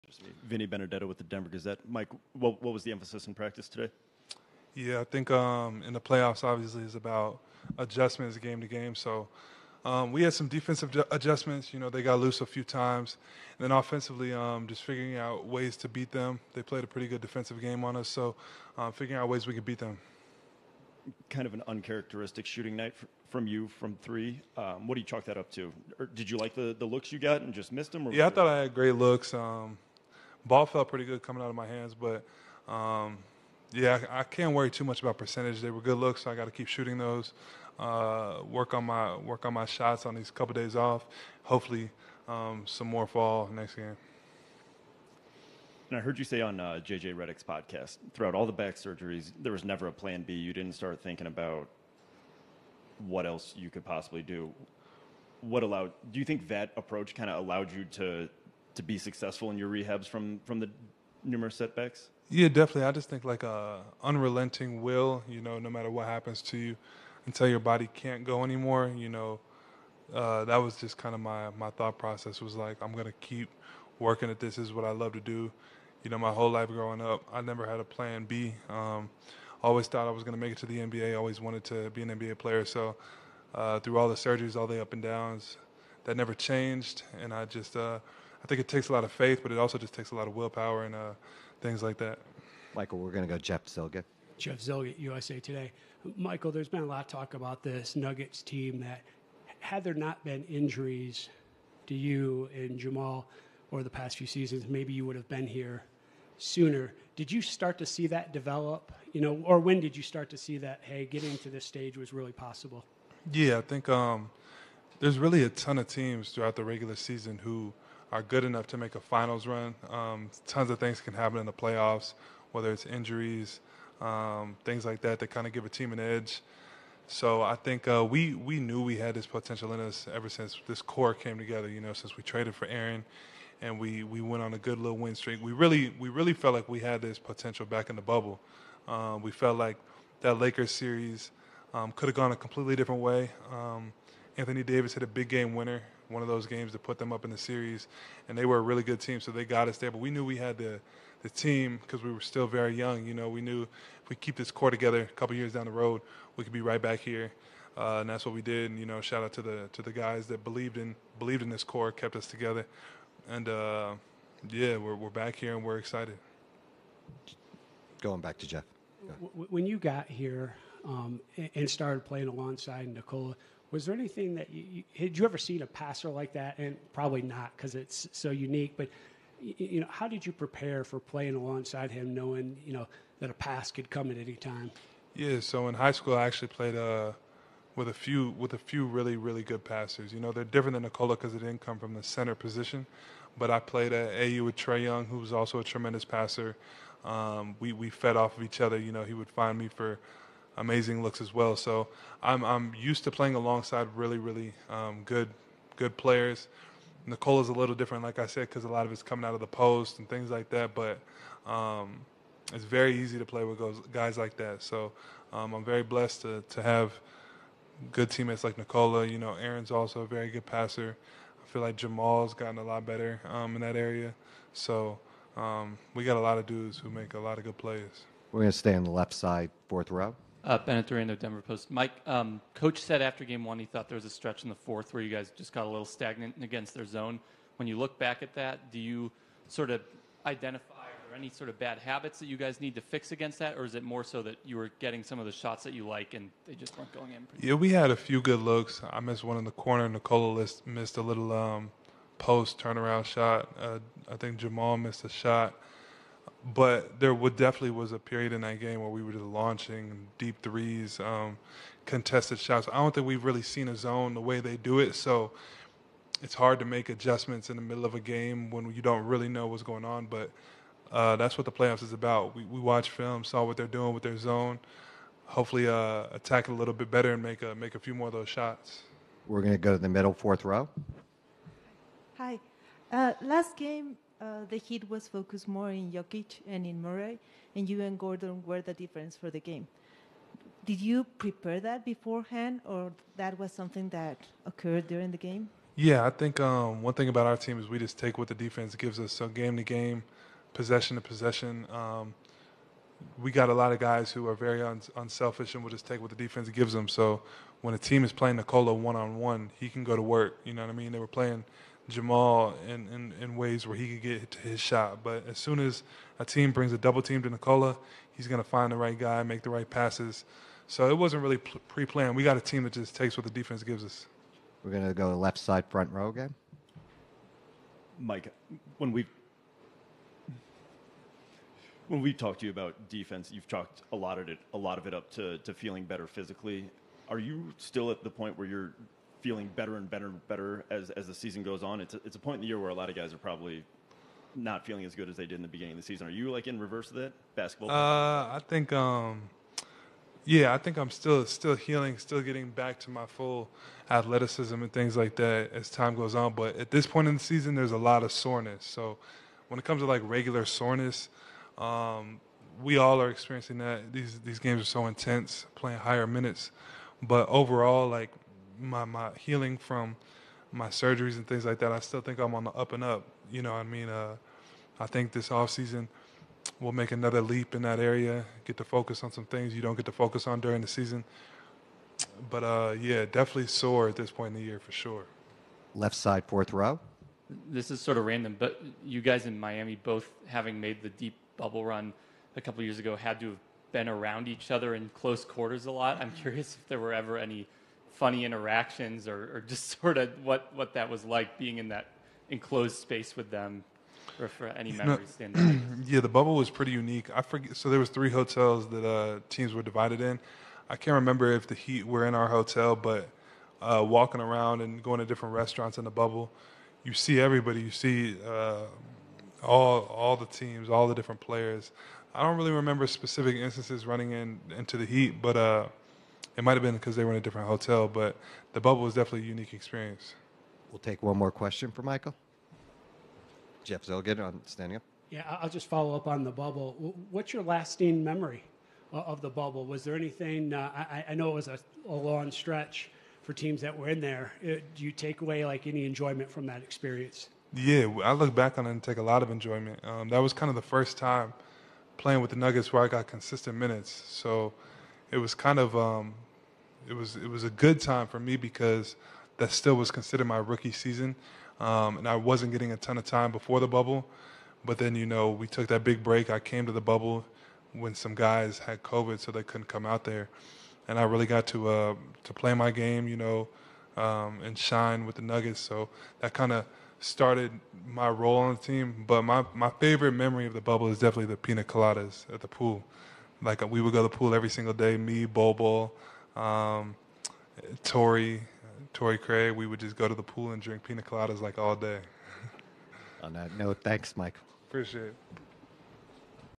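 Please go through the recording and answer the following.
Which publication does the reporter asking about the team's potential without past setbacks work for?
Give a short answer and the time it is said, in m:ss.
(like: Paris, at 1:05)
USA Today, at 1:34.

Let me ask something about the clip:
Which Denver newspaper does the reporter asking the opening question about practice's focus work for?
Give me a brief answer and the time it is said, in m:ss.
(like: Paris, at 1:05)
Denver Gazette, at 0:01.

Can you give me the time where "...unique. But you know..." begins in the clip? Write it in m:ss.
2:58.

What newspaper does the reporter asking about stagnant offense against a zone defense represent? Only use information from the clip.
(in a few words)
Denver Post.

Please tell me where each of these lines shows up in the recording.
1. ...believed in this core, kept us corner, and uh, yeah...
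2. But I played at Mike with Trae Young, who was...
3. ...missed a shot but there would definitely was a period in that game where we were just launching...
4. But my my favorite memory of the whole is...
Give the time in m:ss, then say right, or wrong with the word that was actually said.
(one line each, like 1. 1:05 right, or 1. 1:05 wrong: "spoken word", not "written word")
1. 2:41 wrong: "together", not "corner"
2. 3:13 wrong: "AAU", not "Mike"
3. 4:14 right
4. 7:59 wrong: "bubble", not "whole".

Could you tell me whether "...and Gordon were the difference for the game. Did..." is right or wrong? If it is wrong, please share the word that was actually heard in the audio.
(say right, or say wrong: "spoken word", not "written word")
right.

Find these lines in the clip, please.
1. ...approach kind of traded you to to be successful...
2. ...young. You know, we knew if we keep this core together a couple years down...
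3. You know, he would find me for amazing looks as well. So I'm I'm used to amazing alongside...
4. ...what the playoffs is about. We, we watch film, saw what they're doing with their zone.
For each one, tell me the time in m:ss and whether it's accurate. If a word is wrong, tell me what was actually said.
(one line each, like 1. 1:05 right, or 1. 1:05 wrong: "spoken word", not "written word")
1. 0:56 wrong: "allowed", not "traded"
2. 2:32 right
3. 3:18 wrong: "playing", not "amazing"
4. 4:31 right.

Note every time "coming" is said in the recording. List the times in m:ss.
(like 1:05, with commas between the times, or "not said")
0:31, 3:29.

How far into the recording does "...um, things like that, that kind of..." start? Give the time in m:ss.
2:04.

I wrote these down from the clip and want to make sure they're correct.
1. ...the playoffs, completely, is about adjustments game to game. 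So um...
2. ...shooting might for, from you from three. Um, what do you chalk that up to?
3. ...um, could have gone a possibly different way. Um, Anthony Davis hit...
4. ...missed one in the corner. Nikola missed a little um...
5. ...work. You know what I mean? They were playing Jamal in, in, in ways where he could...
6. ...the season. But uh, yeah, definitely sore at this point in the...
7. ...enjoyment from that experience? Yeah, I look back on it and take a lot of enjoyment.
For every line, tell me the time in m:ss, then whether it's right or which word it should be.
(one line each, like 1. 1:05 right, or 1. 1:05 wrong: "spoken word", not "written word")
1. 0:05 wrong: "obviously", not "completely"
2. 0:22 wrong: "night", not "might"
3. 2:21 wrong: "completely", not "possibly"
4. 4:08 right
5. 5:10 right
6. 6:20 right
7. 7:25 right.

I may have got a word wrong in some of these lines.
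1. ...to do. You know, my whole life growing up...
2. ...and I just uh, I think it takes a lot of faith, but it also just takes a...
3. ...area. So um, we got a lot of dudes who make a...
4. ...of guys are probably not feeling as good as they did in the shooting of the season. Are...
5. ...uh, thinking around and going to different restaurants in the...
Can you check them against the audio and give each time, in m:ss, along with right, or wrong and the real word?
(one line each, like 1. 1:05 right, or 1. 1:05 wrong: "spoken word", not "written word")
1. 1:15 right
2. 1:27 right
3. 3:43 right
4. 5:42 wrong: "beginning", not "shooting"
5. 6:53 wrong: "walking", not "thinking".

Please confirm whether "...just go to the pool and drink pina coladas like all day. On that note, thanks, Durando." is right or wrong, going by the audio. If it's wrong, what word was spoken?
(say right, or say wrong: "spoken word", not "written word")
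wrong: "Mike", not "Durando".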